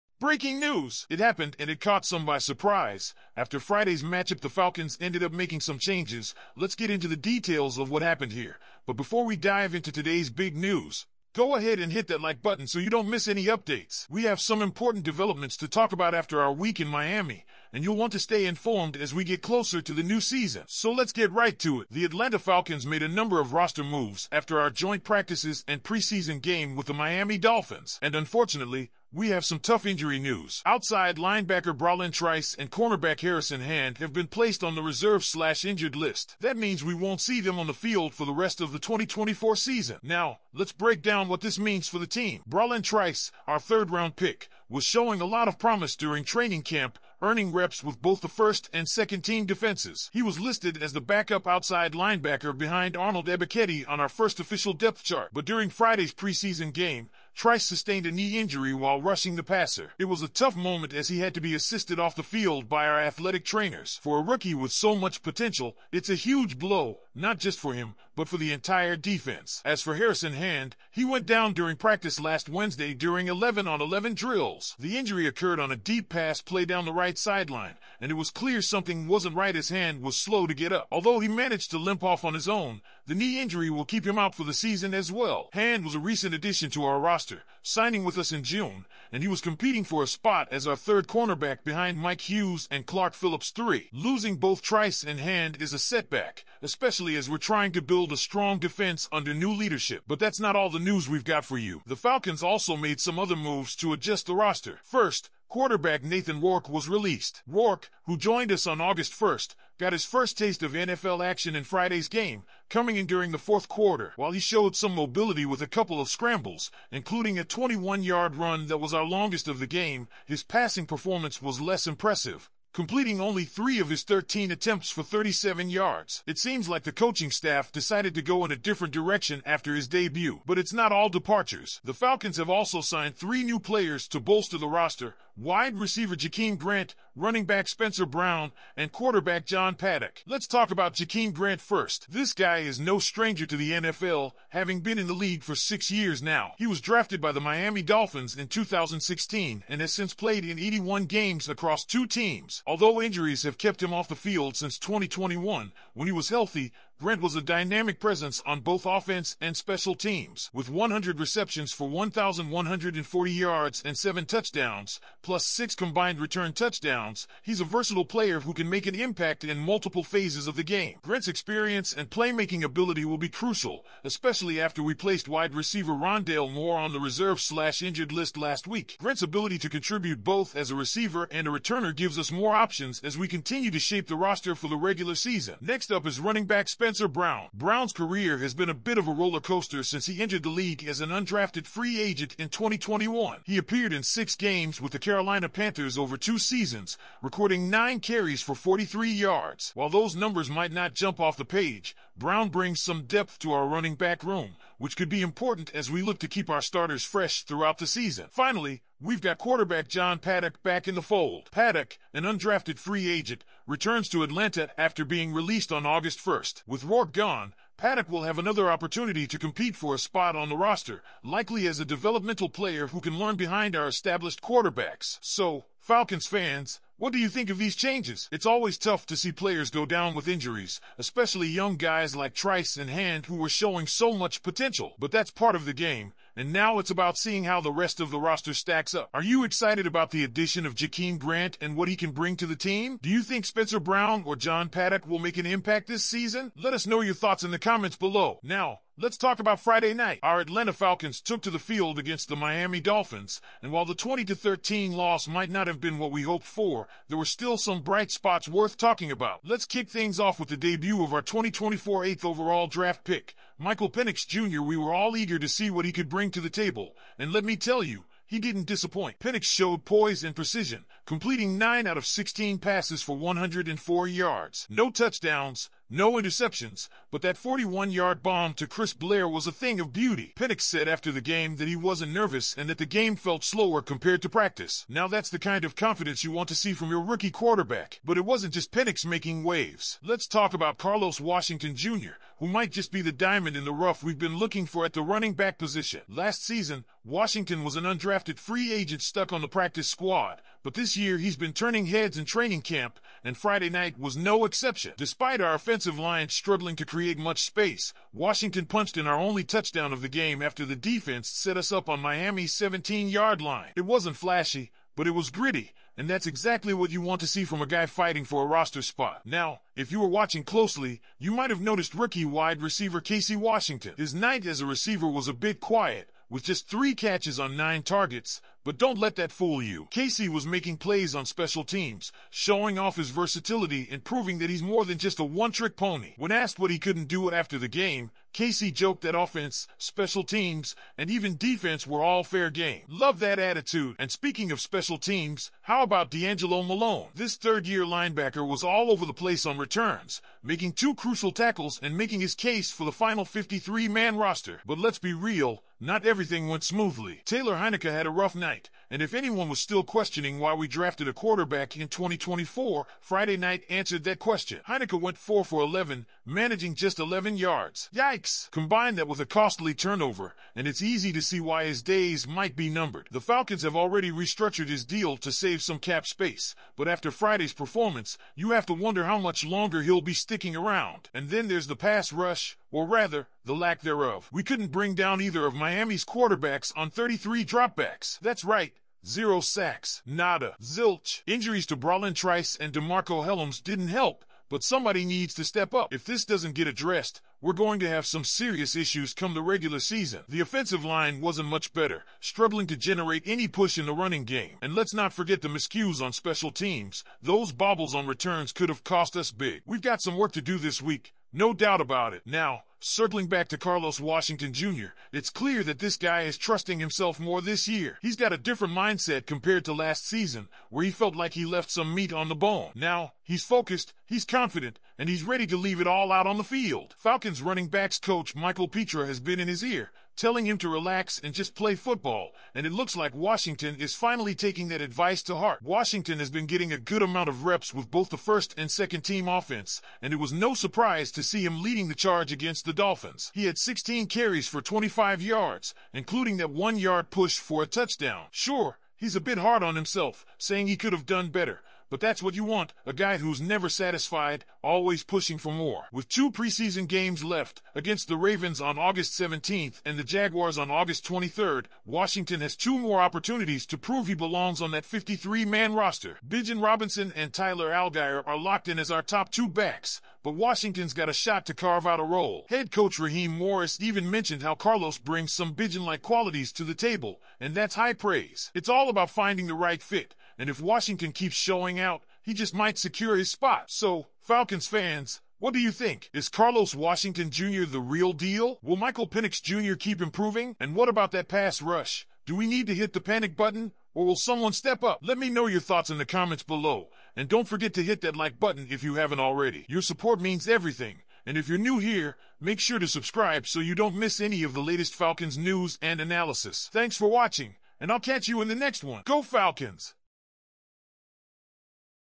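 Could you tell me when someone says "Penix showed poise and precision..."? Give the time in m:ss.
4:29.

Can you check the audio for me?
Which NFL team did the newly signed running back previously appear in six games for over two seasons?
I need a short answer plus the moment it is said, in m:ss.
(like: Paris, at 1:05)
Carolina Panthers, at 3:14.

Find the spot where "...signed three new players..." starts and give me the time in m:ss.
2:12.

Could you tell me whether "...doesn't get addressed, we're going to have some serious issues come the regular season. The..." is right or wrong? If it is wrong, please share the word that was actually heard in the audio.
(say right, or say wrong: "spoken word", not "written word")
right.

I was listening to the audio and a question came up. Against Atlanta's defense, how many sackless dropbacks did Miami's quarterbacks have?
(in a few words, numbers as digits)
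33.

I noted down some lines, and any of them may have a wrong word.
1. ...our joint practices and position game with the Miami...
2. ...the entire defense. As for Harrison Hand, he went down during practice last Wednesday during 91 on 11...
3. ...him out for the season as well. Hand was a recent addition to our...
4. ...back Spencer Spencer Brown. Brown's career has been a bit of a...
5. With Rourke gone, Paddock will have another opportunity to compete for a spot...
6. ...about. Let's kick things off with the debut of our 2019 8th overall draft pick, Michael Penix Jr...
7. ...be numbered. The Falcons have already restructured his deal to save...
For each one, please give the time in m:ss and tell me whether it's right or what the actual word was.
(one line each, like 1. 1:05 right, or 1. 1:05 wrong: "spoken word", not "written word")
1. 0:24 wrong: "preseason", not "position"
2. 1:08 wrong: "11", not "91"
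3. 1:24 right
4. 3:06 right
5. 3:36 right
6. 4:19 wrong: "2024", not "2019"
7. 6:12 right.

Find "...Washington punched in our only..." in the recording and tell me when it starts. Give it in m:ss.
5:08.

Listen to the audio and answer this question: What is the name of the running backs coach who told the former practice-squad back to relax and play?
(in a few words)
Michael Pitre.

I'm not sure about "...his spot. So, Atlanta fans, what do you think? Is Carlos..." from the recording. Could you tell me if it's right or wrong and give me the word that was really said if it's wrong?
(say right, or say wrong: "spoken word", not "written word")
wrong: "Falcons", not "Atlanta".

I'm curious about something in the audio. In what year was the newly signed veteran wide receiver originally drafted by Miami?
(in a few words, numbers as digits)
2016.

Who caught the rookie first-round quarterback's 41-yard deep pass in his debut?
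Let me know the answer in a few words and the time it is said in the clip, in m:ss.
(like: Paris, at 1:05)
Chris Blair, at 4:38.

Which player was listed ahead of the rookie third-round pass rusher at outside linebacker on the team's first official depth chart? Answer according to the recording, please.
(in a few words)
Arnold Ebiketie.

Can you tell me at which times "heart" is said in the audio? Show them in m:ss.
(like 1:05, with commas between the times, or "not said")
7:15.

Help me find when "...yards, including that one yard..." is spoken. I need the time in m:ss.
7:25.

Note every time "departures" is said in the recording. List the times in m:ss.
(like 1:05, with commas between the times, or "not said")
2:11.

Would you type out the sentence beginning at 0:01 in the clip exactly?
It happened and it caught some by surprise.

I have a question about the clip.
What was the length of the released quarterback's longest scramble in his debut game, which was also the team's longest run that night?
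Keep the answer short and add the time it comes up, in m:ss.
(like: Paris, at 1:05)
21 yards, at 1:57.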